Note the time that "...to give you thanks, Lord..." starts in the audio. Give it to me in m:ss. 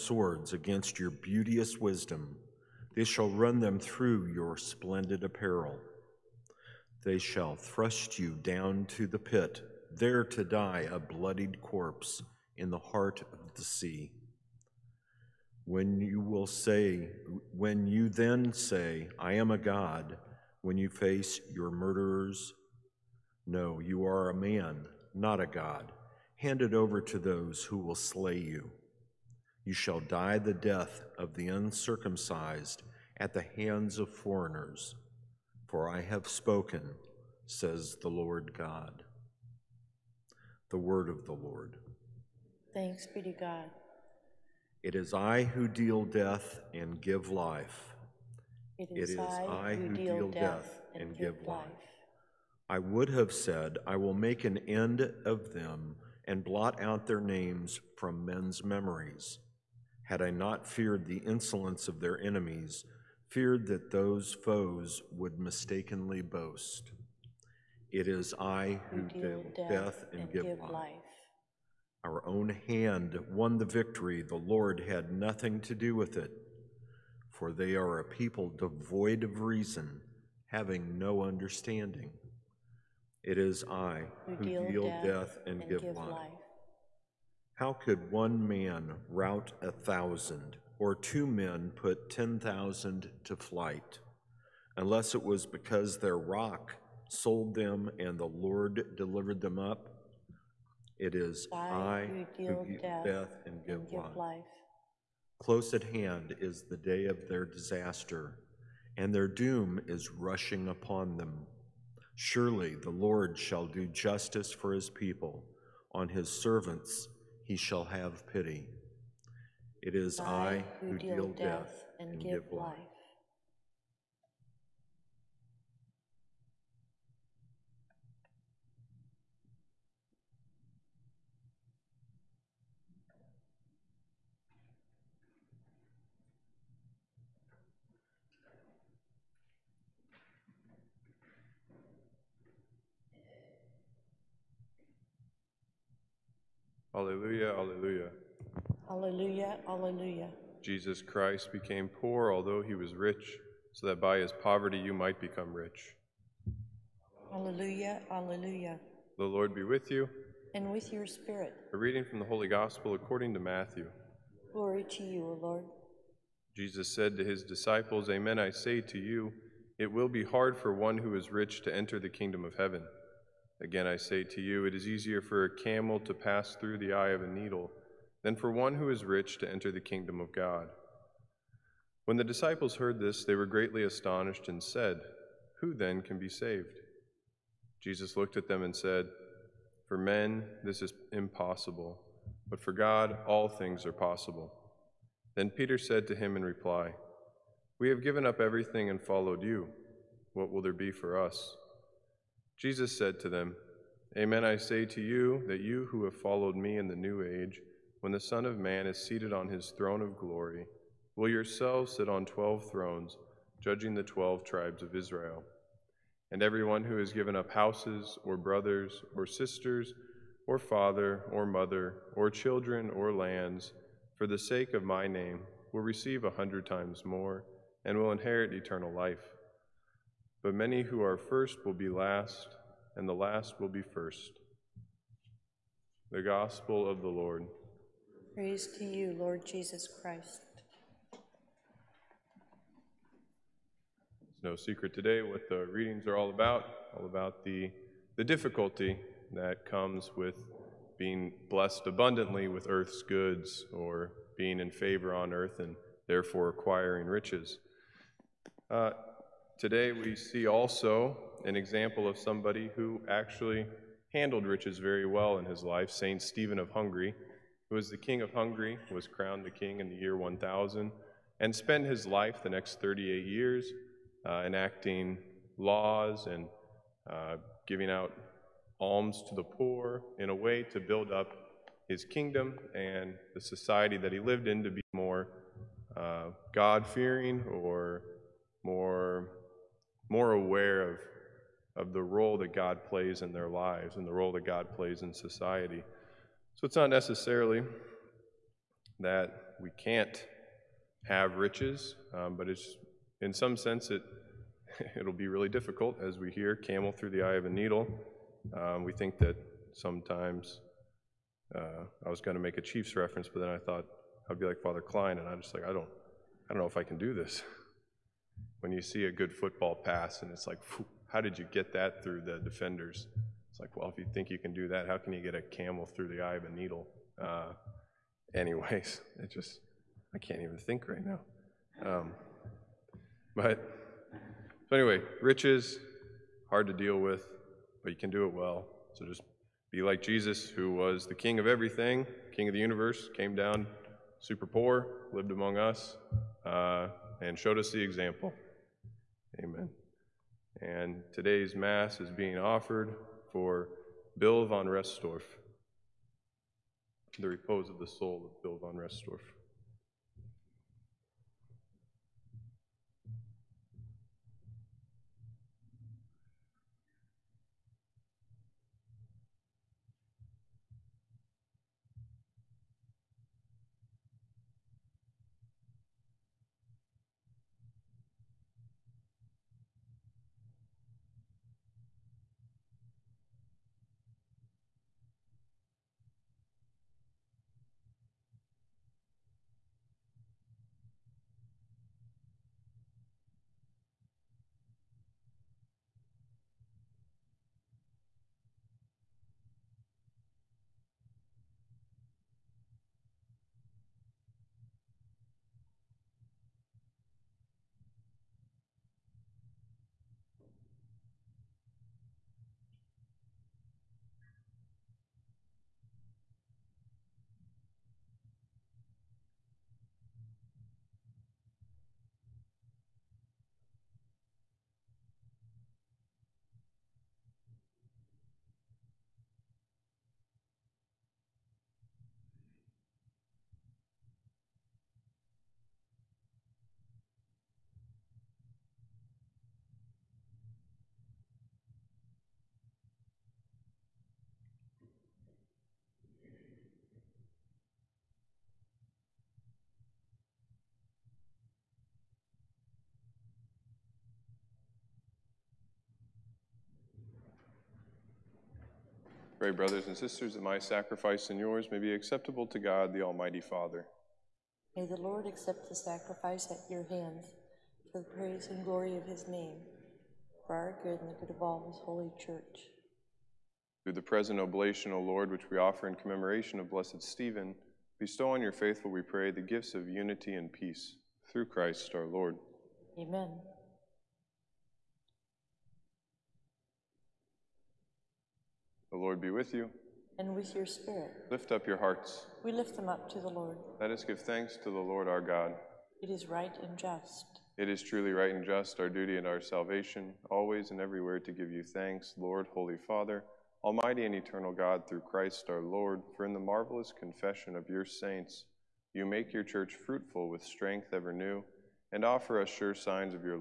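8:21.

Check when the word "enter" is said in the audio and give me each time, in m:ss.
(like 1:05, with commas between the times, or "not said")
2:51, 2:59.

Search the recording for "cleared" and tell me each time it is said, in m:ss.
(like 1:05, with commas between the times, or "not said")
not said.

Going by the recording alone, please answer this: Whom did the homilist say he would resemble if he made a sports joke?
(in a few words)
Father Klein.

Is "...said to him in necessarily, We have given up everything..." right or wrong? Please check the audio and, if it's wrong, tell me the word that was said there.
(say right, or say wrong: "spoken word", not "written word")
wrong: "reply", not "necessarily".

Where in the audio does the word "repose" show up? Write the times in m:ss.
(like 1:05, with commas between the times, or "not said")
5:57.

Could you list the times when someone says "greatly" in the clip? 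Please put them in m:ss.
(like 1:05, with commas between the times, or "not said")
3:03.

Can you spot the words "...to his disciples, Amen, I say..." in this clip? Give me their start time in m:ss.
2:47.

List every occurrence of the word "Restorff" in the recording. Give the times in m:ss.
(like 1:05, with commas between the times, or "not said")
5:54, 5:58.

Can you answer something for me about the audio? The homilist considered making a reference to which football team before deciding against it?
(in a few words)
Chiefs.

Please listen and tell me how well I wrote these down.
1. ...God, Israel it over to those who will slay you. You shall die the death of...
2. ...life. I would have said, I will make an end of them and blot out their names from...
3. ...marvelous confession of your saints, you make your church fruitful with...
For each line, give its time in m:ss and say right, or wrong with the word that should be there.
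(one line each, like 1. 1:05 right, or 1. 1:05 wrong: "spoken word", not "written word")
1. 0:25 wrong: "Hand", not "Israel"
2. 0:51 right
3. 8:26 right.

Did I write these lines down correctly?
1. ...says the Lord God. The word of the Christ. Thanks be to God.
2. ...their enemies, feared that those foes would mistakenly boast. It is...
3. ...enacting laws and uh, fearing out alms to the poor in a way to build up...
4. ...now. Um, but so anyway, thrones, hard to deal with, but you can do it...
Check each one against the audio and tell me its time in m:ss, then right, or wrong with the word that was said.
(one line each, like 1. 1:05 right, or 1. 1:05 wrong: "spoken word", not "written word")
1. 0:37 wrong: "Lord", not "Christ"
2. 1:01 right
3. 4:34 wrong: "giving", not "fearing"
4. 5:31 wrong: "riches", not "thrones".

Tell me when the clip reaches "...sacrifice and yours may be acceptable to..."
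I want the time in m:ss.
7:40.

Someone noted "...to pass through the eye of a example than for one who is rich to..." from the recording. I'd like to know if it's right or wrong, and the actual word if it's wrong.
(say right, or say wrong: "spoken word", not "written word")
wrong: "needle", not "example".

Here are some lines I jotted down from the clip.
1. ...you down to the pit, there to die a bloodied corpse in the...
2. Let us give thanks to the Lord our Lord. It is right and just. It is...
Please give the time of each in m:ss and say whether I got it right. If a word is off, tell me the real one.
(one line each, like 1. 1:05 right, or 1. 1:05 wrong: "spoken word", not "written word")
1. 0:08 right
2. 8:13 wrong: "God", not "Lord".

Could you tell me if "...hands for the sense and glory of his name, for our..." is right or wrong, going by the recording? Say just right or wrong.
wrong.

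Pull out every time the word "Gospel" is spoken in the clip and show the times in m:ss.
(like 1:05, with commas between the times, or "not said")
2:42, 3:56.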